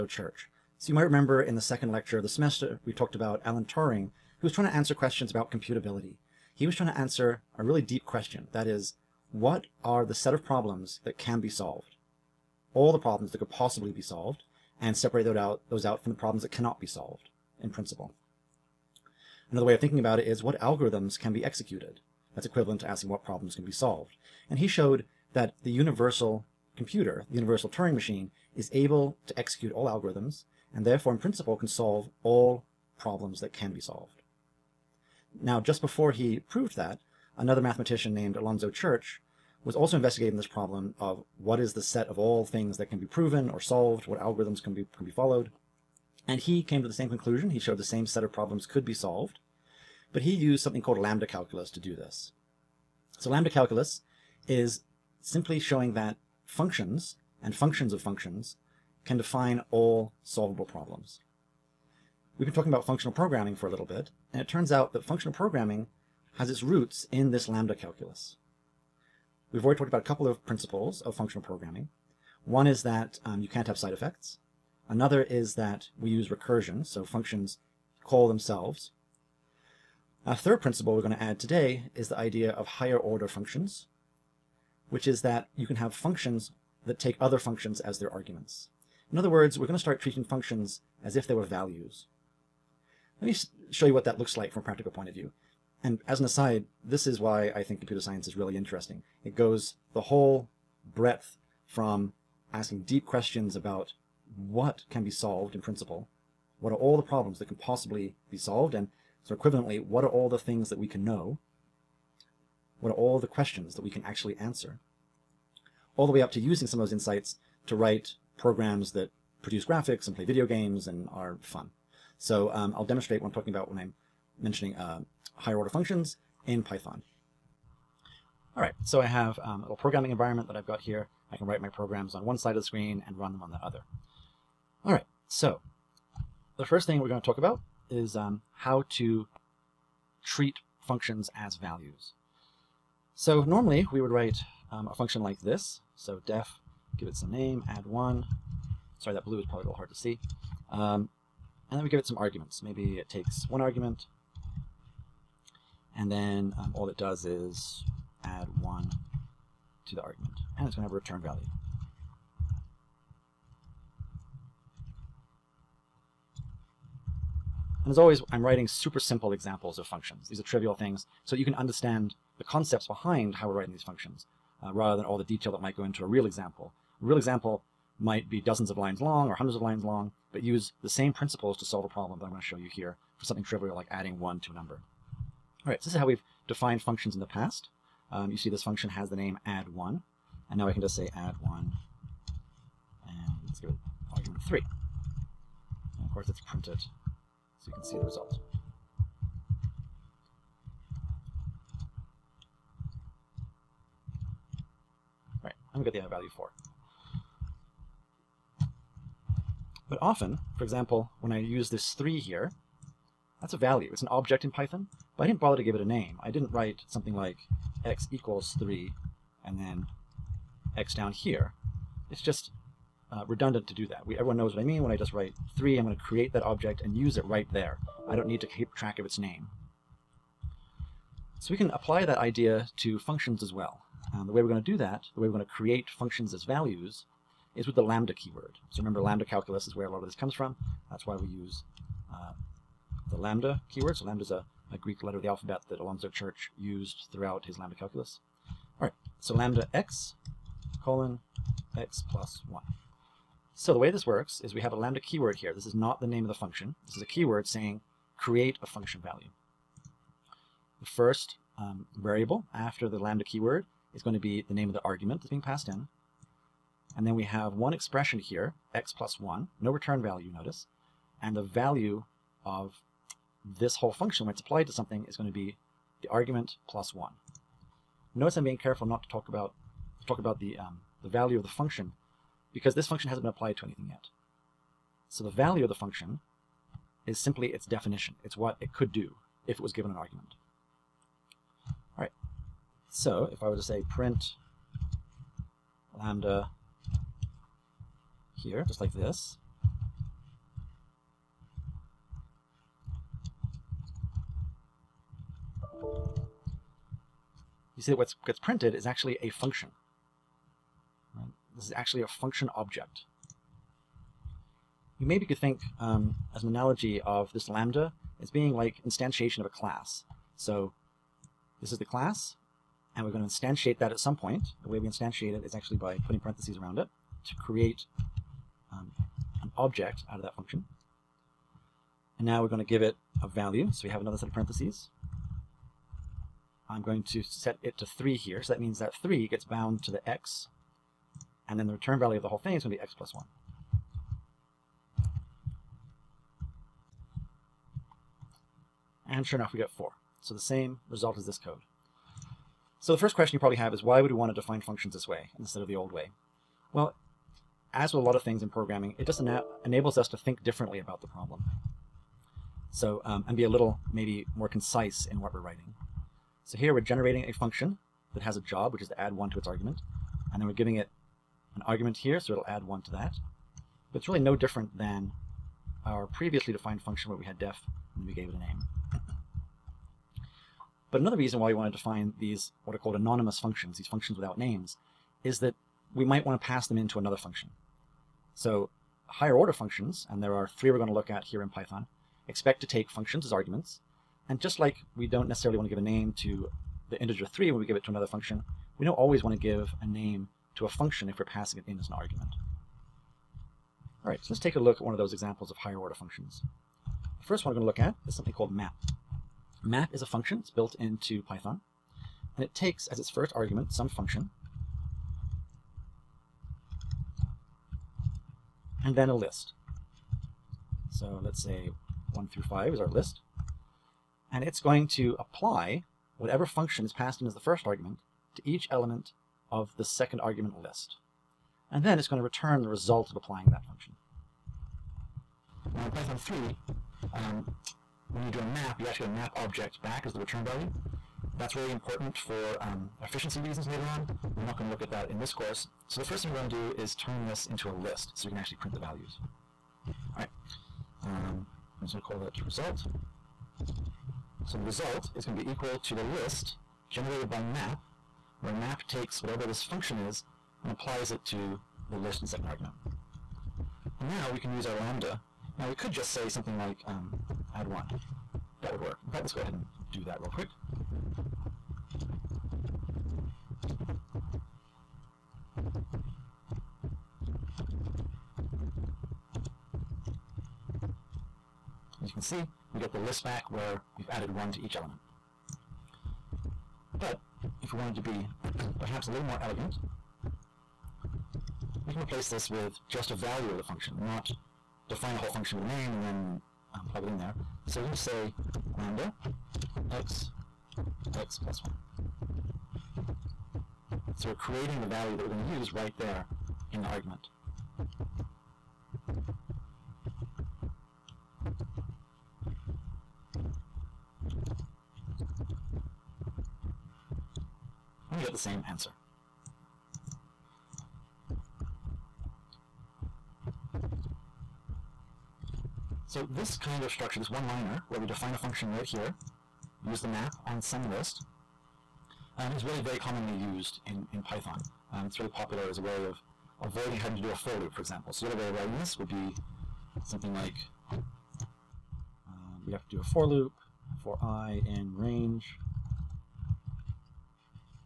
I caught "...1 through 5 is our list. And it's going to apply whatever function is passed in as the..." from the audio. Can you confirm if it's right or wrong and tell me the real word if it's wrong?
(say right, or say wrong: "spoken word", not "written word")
right.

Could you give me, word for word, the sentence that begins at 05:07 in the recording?
You see that what gets printed is actually a function.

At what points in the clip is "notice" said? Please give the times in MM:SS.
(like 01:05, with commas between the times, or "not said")
04:30, 04:38.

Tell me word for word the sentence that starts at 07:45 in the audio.
Now we could just say something like um, add one.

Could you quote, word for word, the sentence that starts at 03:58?
So remember, lambda calculus is where a lot of this comes from.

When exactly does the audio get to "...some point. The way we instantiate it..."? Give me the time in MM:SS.
05:23.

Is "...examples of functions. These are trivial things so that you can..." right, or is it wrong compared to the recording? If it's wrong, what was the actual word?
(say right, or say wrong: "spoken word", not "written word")
right.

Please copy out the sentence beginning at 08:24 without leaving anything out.
So we're creating the value that we're going to use right there in the argument.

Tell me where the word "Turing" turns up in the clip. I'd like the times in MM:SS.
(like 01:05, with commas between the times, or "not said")
00:03, 00:27.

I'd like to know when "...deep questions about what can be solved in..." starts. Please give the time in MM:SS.
01:42.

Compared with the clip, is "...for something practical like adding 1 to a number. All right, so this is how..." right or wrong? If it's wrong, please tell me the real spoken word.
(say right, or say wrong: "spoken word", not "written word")
wrong: "trivial", not "practical".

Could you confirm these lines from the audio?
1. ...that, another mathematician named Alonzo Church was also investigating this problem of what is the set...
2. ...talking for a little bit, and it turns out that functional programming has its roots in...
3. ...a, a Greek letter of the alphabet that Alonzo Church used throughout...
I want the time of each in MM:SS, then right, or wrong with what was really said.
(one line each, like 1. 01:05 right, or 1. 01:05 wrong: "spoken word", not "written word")
1. 00:36 right
2. 01:03 wrong: "programming", not "talking"
3. 04:04 right.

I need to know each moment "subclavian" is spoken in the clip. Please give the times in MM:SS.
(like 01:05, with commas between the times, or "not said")
not said.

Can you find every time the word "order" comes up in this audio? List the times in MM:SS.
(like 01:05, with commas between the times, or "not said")
01:22, 02:05, 06:29, 06:45.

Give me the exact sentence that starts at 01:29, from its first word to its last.
In other words, we're going to start treating functions as if they were values.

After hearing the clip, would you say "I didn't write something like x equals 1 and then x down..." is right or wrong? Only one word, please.
wrong.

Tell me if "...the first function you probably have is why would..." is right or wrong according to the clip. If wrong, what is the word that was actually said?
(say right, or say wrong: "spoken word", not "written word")
wrong: "question", not "function".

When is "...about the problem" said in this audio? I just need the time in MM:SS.
06:00.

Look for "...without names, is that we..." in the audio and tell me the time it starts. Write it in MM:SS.
06:24.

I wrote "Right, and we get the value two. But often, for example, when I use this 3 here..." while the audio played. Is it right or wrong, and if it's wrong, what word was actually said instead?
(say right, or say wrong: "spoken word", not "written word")
wrong: "four", not "two".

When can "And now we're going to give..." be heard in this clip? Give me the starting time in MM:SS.
05:32.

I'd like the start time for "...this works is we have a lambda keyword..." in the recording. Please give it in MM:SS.
04:13.